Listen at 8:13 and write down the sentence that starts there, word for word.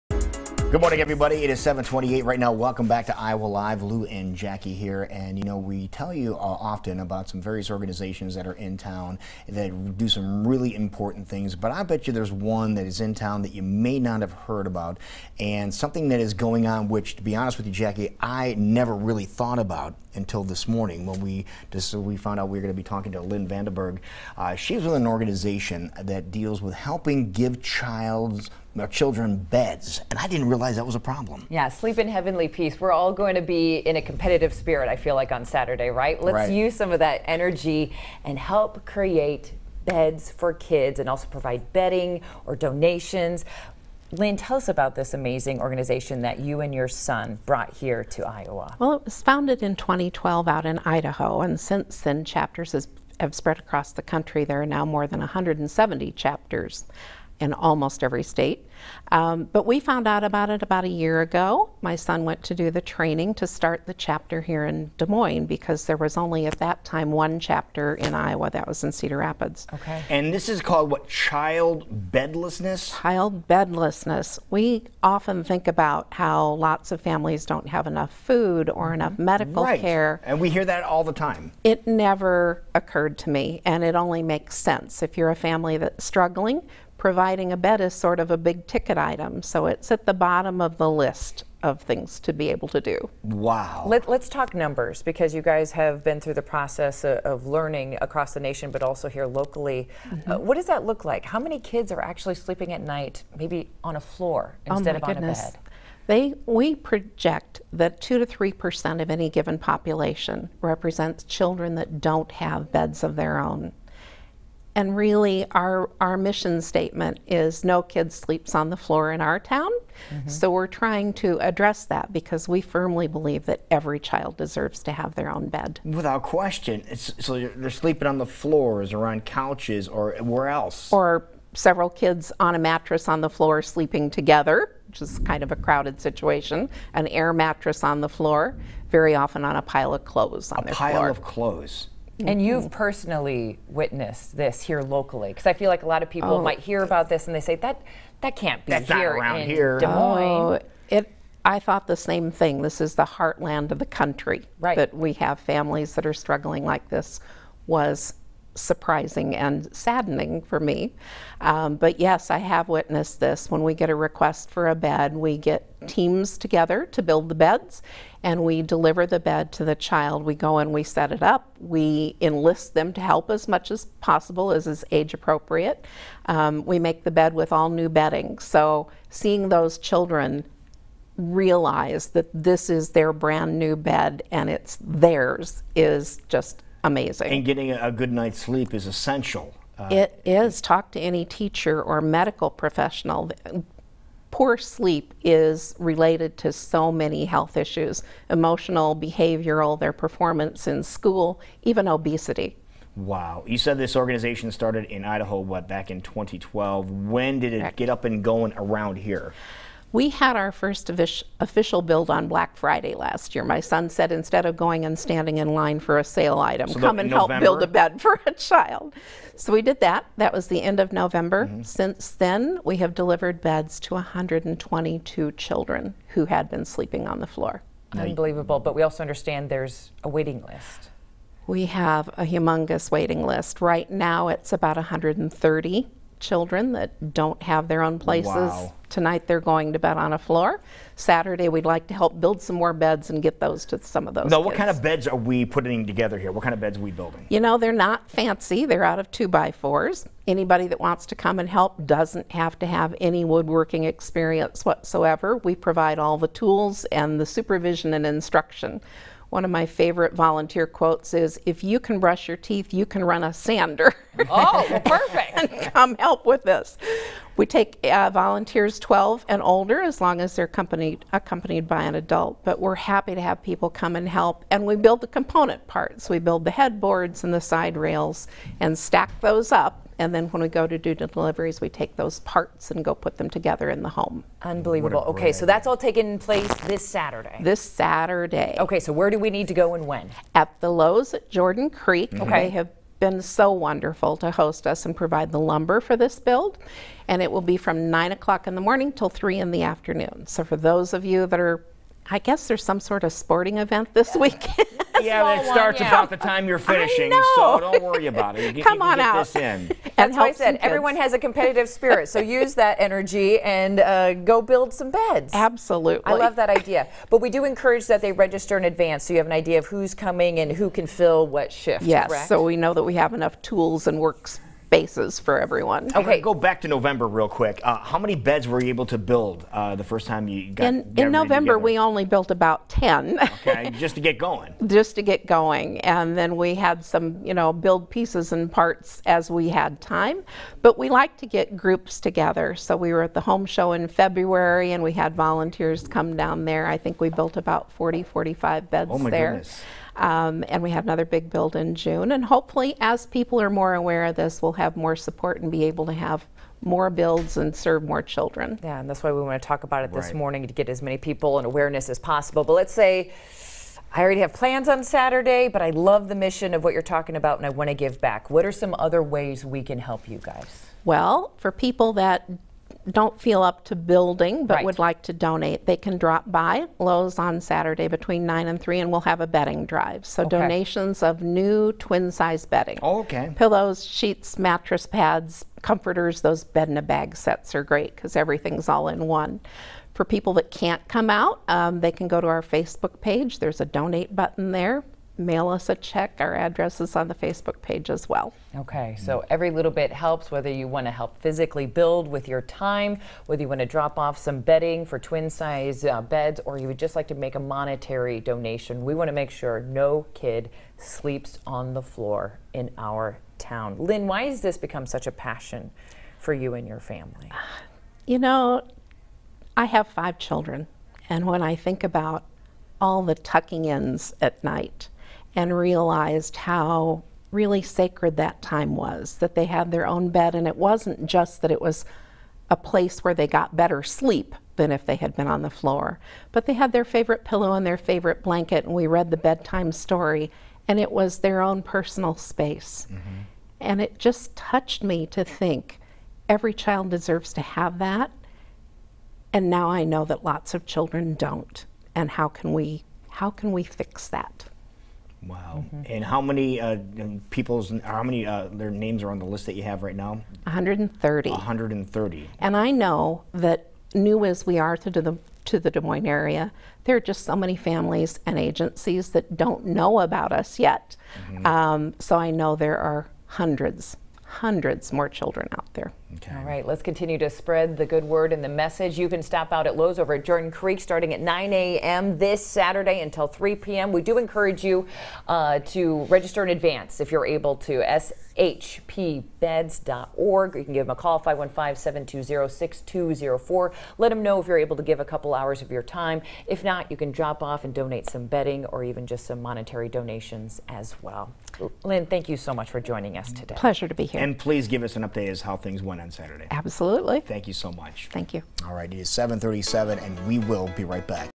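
Let them know if you're able to give a couple hours of your time.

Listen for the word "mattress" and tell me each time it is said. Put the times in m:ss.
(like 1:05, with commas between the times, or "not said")
2:12, 2:17, 6:24.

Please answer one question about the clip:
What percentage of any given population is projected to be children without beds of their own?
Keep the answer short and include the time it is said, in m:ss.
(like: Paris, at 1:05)
2 to 3 percent, at 1:48.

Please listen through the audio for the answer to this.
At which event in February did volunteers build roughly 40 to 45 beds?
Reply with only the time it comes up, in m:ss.
5:43.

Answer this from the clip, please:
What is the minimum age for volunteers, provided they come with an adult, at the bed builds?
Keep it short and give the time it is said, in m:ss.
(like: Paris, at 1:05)
12, at 4:28.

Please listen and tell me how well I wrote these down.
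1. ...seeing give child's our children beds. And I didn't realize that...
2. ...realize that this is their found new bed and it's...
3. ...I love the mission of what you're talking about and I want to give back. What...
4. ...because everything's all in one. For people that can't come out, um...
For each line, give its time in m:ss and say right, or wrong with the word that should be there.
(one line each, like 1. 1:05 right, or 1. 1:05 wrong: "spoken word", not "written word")
1. 0:26 wrong: "helping", not "seeing"
2. 3:01 wrong: "brand", not "found"
3. 6:05 right
4. 6:27 right.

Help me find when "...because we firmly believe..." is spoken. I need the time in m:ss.
2:02.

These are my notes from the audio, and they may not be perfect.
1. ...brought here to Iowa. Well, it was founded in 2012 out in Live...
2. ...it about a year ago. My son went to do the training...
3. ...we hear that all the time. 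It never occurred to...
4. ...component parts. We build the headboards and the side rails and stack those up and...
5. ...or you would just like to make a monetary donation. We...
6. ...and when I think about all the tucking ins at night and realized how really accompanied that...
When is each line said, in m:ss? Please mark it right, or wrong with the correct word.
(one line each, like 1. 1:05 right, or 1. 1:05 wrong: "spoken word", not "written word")
1. 0:47 wrong: "Idaho", not "Live"
2. 1:00 right
3. 1:20 right
4. 4:35 right
5. 6:46 right
6. 7:01 wrong: "sacred", not "accompanied".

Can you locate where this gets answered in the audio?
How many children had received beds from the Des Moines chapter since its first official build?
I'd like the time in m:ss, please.
3:43.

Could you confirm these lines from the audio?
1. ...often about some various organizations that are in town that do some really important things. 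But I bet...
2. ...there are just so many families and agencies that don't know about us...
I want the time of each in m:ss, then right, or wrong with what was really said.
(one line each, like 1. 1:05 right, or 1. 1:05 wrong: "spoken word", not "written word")
1. 0:06 right
2. 7:46 right.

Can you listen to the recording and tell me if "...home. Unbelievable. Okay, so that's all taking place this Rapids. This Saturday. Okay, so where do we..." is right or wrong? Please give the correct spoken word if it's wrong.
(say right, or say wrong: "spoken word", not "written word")
wrong: "Saturday", not "Rapids".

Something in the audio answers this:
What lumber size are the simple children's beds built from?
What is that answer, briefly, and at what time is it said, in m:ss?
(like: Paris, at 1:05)
Two by fours, at 4:09.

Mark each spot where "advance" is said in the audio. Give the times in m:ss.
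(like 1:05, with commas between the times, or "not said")
5:18, 8:06.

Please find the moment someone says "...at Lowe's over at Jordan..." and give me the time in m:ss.
7:59.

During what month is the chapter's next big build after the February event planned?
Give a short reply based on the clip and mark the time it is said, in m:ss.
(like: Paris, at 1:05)
June, at 5:51.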